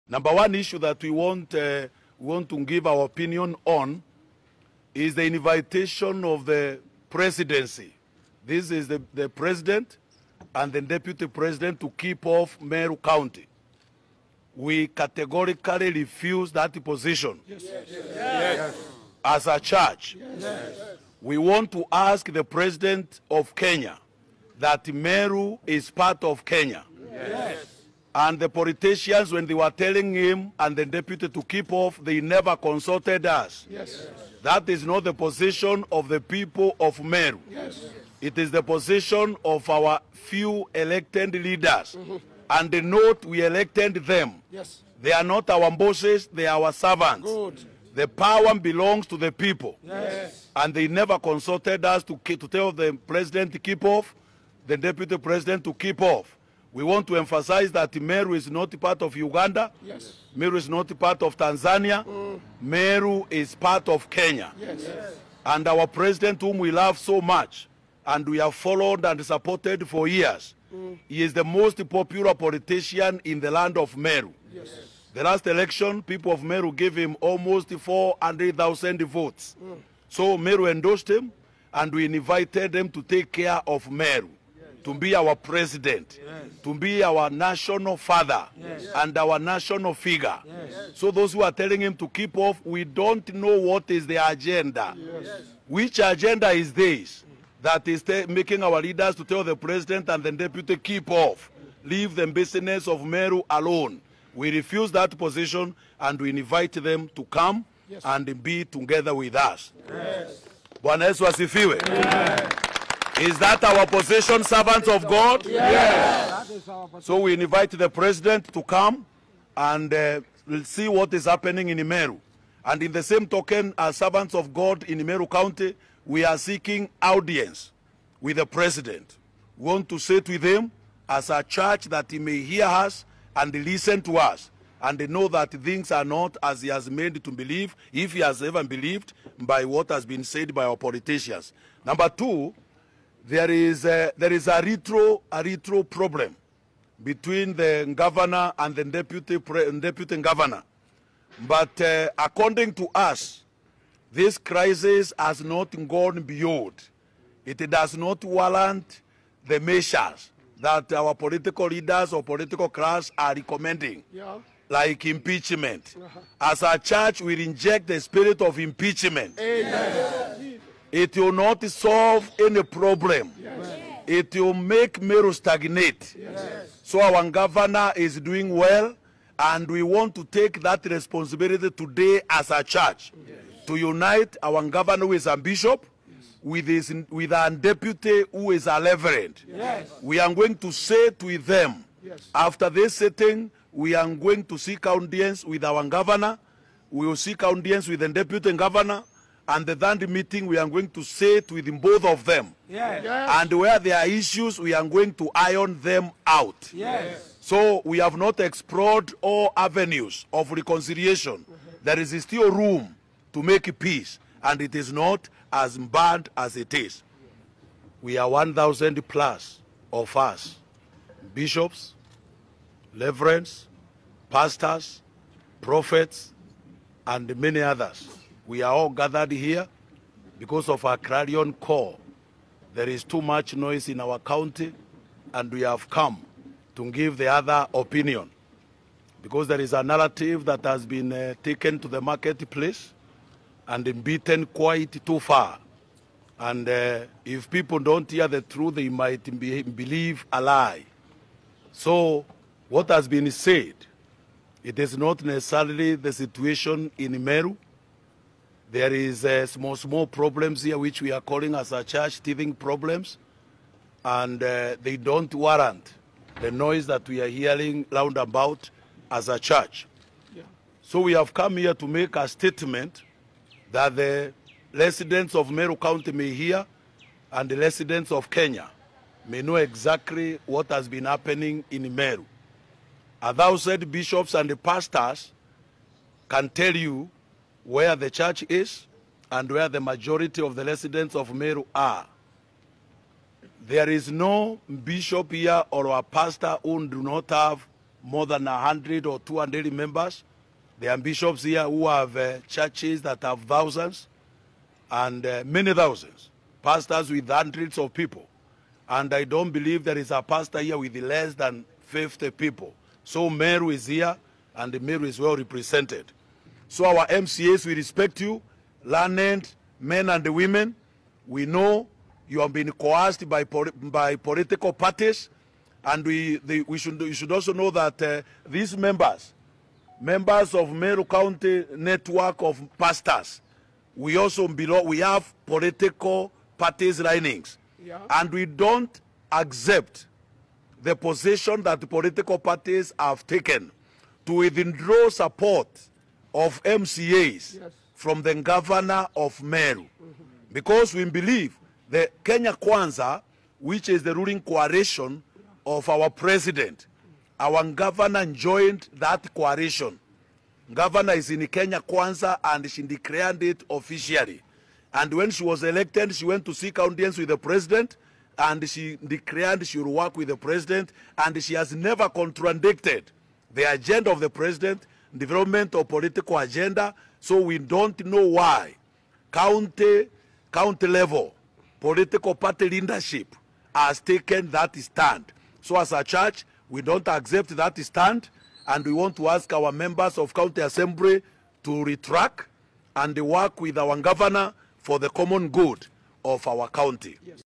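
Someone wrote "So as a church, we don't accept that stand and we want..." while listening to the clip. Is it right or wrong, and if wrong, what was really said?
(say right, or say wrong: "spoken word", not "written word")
right.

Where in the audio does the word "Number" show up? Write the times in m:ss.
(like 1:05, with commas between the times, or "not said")
0:00, 2:21.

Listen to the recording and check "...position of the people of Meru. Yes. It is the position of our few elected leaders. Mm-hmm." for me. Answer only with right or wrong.
right.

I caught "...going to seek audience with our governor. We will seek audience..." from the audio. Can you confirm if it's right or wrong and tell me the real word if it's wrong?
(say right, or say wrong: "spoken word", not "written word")
right.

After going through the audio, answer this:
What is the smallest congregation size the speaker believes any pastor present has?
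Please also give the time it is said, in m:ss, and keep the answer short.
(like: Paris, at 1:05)
50 people, at 5:11.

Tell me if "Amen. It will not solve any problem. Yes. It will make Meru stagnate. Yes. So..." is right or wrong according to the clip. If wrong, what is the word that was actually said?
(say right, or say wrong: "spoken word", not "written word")
right.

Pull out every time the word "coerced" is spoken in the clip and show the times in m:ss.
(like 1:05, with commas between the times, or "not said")
5:22.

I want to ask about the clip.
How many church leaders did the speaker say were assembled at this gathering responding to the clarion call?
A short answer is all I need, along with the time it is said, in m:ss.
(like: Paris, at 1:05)
1,000 plus, at 3:38.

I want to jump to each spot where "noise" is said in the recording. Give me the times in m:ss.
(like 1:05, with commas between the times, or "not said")
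3:53, 4:26.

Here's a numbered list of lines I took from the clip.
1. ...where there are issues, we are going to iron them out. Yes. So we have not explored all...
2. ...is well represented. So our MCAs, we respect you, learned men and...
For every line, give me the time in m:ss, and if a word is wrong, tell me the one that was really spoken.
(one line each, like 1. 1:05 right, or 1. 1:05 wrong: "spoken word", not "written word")
1. 3:23 right
2. 5:15 right.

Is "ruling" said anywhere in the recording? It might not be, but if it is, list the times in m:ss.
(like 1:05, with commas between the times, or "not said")
5:54.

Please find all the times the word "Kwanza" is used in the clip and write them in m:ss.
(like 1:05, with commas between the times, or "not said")
5:52, 6:01.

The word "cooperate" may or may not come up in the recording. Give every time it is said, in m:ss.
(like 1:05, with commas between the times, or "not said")
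not said.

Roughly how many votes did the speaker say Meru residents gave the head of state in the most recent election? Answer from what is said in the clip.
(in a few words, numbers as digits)
400,000.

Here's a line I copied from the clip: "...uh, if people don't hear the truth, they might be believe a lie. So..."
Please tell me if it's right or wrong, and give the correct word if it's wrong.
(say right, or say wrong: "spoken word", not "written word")
right.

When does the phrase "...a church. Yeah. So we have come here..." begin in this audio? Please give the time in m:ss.
4:29.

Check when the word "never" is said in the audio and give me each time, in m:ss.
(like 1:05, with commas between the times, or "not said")
0:32, 0:50, 6:11.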